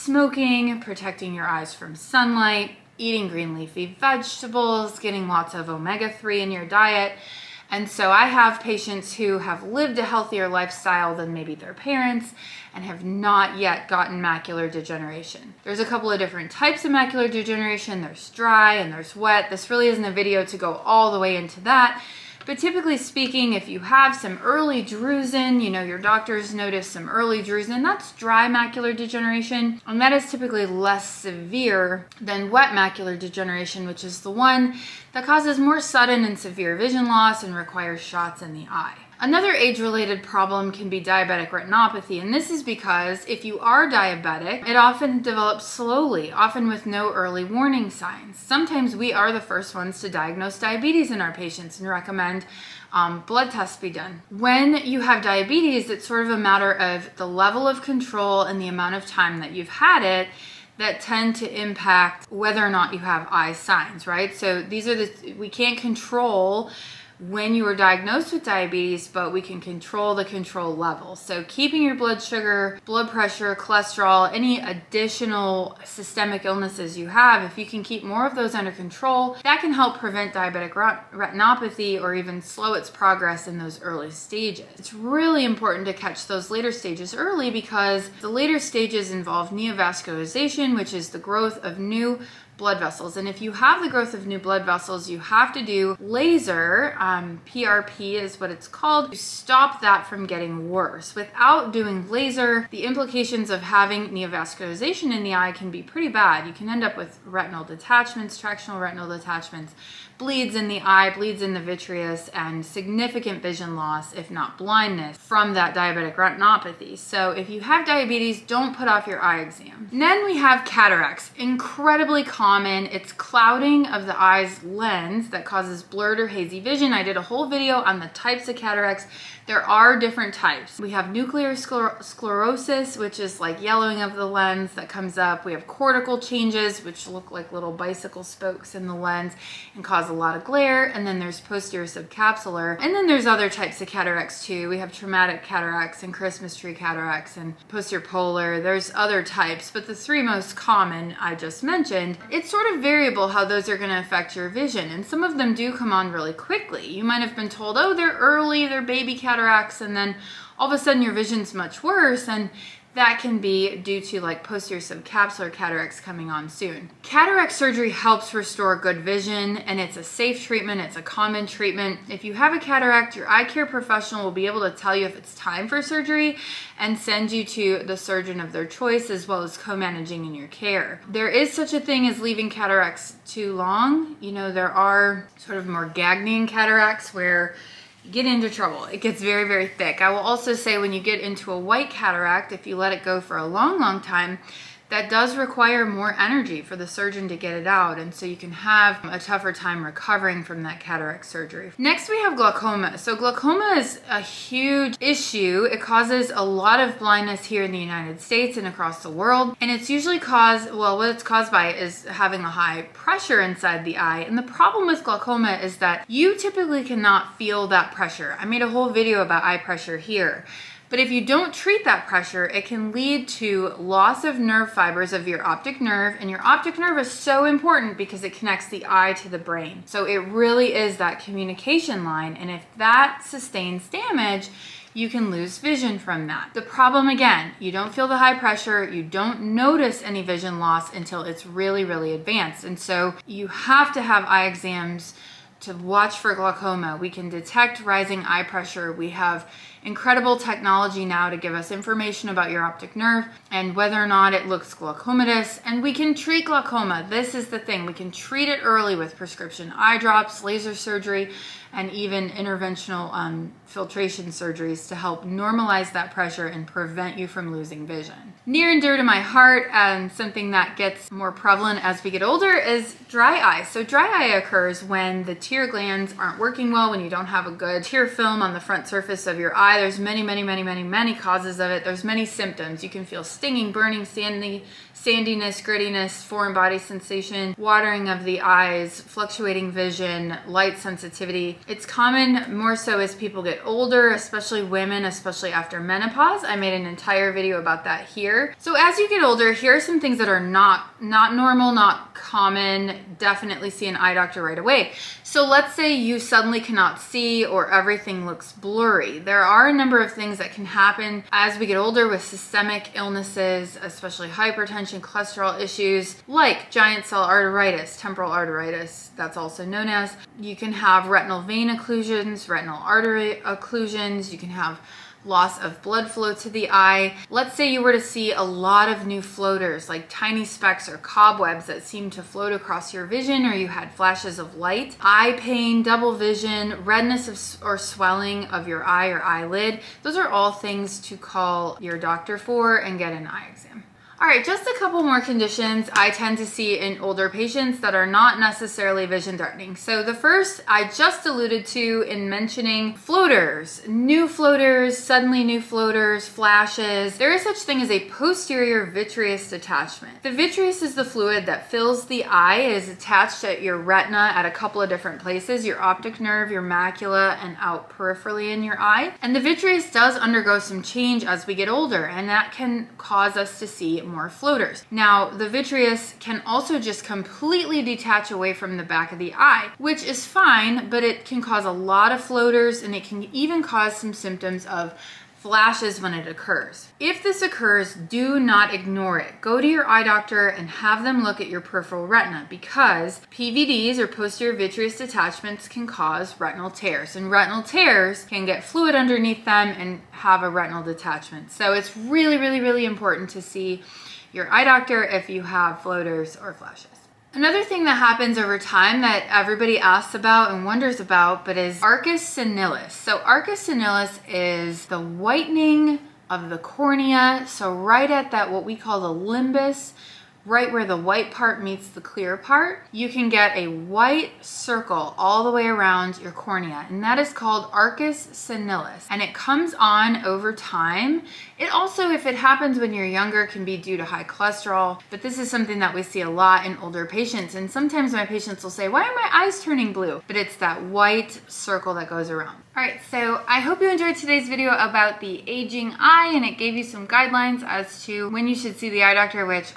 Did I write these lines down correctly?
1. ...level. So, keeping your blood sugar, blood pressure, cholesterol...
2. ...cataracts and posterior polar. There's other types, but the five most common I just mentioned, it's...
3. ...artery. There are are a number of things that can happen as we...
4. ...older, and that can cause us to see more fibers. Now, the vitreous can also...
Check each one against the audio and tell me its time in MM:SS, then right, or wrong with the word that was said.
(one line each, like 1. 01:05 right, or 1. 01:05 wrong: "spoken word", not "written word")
1. 01:10 right
2. 02:26 wrong: "three", not "five"
3. 05:08 wrong: "blurry", not "artery"
4. 06:11 wrong: "floaters", not "fibers".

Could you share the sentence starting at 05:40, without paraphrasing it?
Those are all things to call your doctor for and get an eye exam.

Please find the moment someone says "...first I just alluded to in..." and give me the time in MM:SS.
05:50.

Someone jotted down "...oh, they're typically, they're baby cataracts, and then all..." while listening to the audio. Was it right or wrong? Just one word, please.
wrong.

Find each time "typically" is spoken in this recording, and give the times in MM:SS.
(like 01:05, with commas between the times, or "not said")
00:22, 00:30, 03:36.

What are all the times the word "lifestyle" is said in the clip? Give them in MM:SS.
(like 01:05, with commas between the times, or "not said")
00:10.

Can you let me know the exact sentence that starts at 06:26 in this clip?
If this occurs, do not ignore it.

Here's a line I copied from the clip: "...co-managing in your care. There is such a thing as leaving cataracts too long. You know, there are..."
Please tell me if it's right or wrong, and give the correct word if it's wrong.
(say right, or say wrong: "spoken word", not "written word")
right.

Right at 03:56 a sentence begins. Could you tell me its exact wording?
The problem again, you don't feel the high pressure, you don't notice any vision loss until it's really, really advanced.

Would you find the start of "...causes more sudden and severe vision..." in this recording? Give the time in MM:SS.
00:35.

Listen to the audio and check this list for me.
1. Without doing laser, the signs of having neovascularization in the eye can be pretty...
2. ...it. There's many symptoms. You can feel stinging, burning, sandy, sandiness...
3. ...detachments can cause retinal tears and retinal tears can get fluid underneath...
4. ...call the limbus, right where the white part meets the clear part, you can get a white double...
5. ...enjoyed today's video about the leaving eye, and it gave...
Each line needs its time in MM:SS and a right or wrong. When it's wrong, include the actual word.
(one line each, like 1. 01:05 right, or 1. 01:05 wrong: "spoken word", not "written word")
1. 01:41 wrong: "implications", not "signs"
2. 04:41 right
3. 06:34 right
4. 06:58 wrong: "circle", not "double"
5. 07:23 wrong: "aging", not "leaving".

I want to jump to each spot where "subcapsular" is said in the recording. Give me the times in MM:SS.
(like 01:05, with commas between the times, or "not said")
02:21, 02:44.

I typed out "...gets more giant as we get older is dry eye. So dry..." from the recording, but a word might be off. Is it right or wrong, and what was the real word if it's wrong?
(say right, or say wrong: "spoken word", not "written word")
wrong: "prevalent", not "giant".